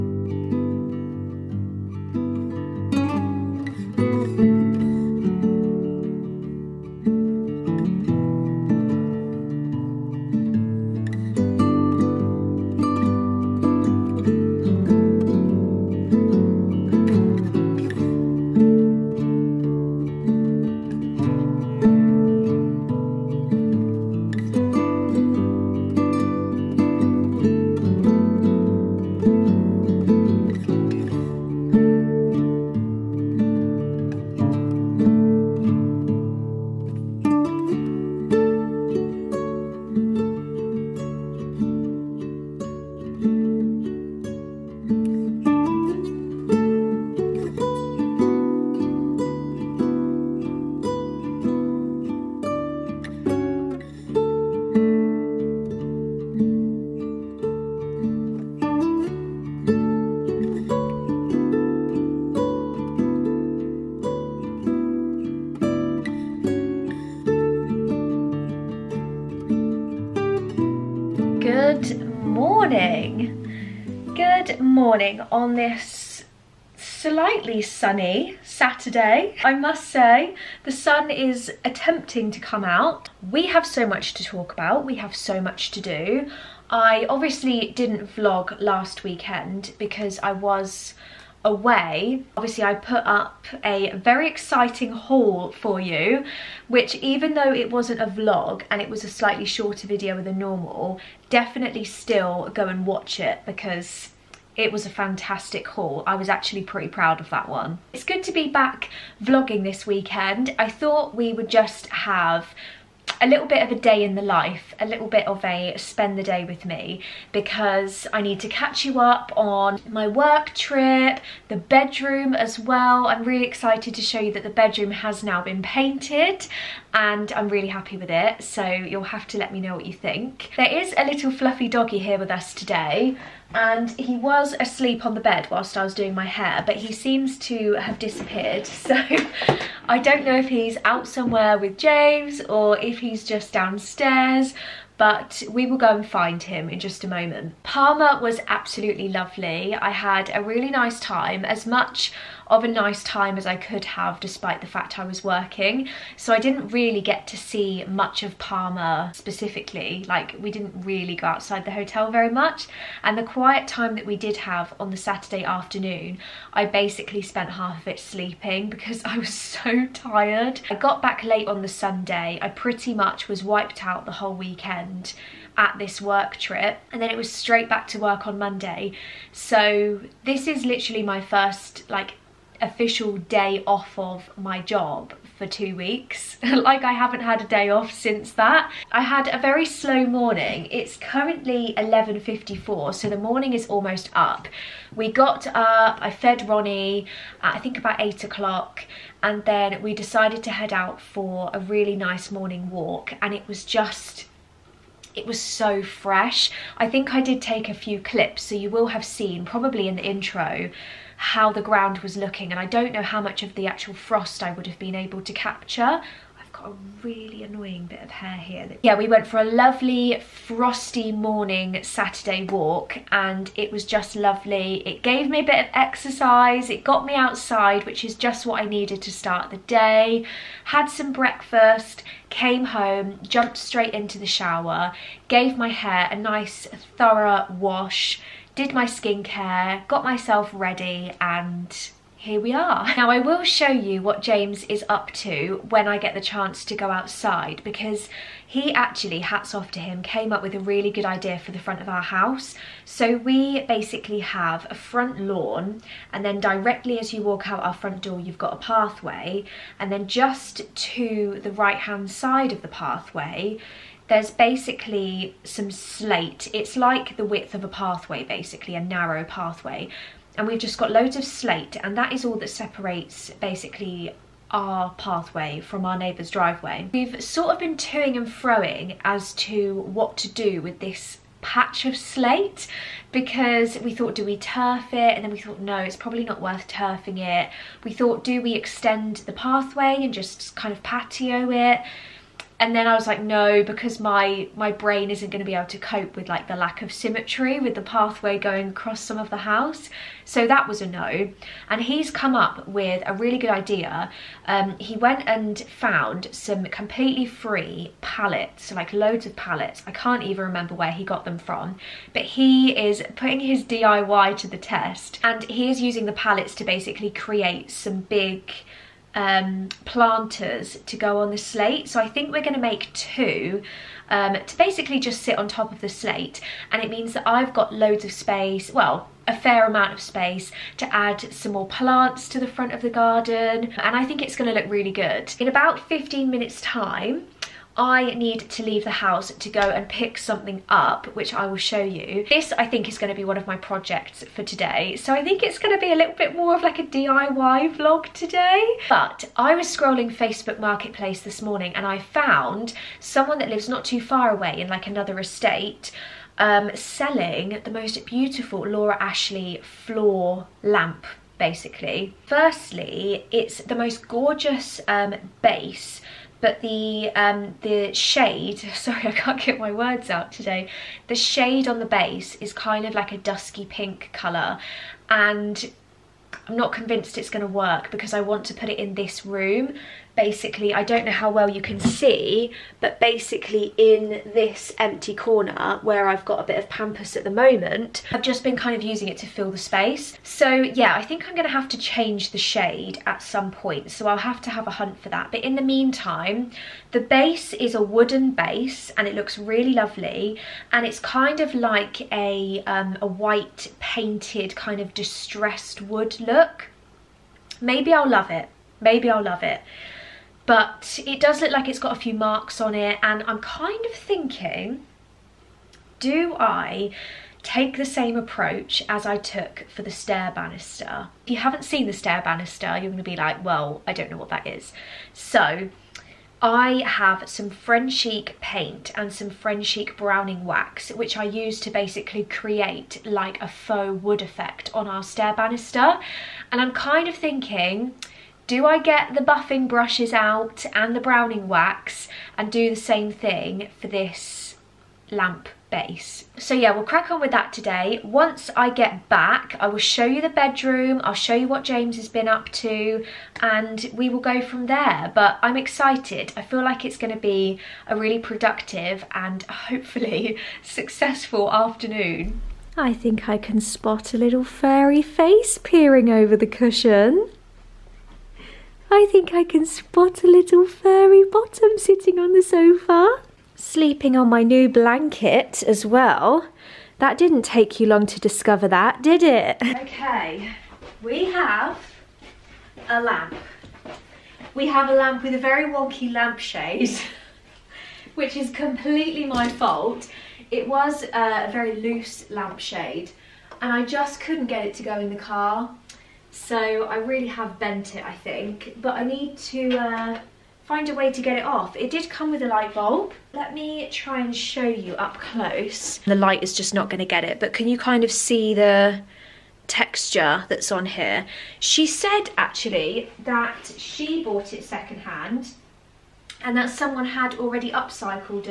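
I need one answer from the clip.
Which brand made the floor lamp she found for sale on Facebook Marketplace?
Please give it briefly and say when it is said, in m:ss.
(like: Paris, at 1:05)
Laura Ashley, at 5:58.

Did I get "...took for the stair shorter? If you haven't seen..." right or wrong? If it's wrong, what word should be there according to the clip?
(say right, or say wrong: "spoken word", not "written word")
wrong: "banister", not "shorter".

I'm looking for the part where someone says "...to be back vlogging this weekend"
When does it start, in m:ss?
1:48.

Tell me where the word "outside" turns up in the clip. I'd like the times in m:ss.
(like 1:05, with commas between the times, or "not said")
2:41, 3:47, 4:06.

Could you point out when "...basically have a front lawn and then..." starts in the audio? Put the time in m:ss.
4:13.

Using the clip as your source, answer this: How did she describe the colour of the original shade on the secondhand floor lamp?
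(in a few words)
Dusky pink.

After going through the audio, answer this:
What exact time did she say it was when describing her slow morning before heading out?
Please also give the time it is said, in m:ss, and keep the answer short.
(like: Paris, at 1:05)
11.54, at 3:11.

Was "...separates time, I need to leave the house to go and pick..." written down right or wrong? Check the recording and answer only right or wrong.
wrong.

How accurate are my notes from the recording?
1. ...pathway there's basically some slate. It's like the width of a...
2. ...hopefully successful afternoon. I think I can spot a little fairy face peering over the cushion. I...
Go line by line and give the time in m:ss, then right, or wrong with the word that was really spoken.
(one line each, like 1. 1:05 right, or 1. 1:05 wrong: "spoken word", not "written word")
1. 4:22 right
2. 7:39 right.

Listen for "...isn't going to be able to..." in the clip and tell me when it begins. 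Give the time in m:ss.
4:55.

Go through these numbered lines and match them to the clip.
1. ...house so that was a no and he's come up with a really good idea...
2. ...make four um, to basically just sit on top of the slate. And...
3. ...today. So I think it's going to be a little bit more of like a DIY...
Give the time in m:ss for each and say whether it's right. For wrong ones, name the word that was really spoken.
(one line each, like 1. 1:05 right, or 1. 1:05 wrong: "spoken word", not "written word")
1. 4:59 right
2. 5:22 wrong: "two", not "four"
3. 5:44 right.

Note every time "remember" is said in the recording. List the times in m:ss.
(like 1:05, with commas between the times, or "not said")
5:10.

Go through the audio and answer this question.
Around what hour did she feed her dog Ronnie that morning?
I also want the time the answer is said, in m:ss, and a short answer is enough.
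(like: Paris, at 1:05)
8 o'clock, at 3:17.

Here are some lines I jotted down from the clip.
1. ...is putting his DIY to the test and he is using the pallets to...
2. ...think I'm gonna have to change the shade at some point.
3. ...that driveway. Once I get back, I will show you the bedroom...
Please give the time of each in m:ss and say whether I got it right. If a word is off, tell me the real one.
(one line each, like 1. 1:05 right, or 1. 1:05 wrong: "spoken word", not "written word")
1. 5:12 right
2. 6:31 right
3. 7:27 wrong: "today", not "driveway".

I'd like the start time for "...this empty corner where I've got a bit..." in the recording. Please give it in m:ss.
6:24.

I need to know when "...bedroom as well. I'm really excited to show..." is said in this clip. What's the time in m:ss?
2:01.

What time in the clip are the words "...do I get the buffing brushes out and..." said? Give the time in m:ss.
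7:18.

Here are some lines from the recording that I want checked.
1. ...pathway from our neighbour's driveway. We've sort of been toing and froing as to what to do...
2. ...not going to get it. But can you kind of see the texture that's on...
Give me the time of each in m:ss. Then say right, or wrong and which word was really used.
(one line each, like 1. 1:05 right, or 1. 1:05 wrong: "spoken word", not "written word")
1. 4:34 right
2. 8:26 right.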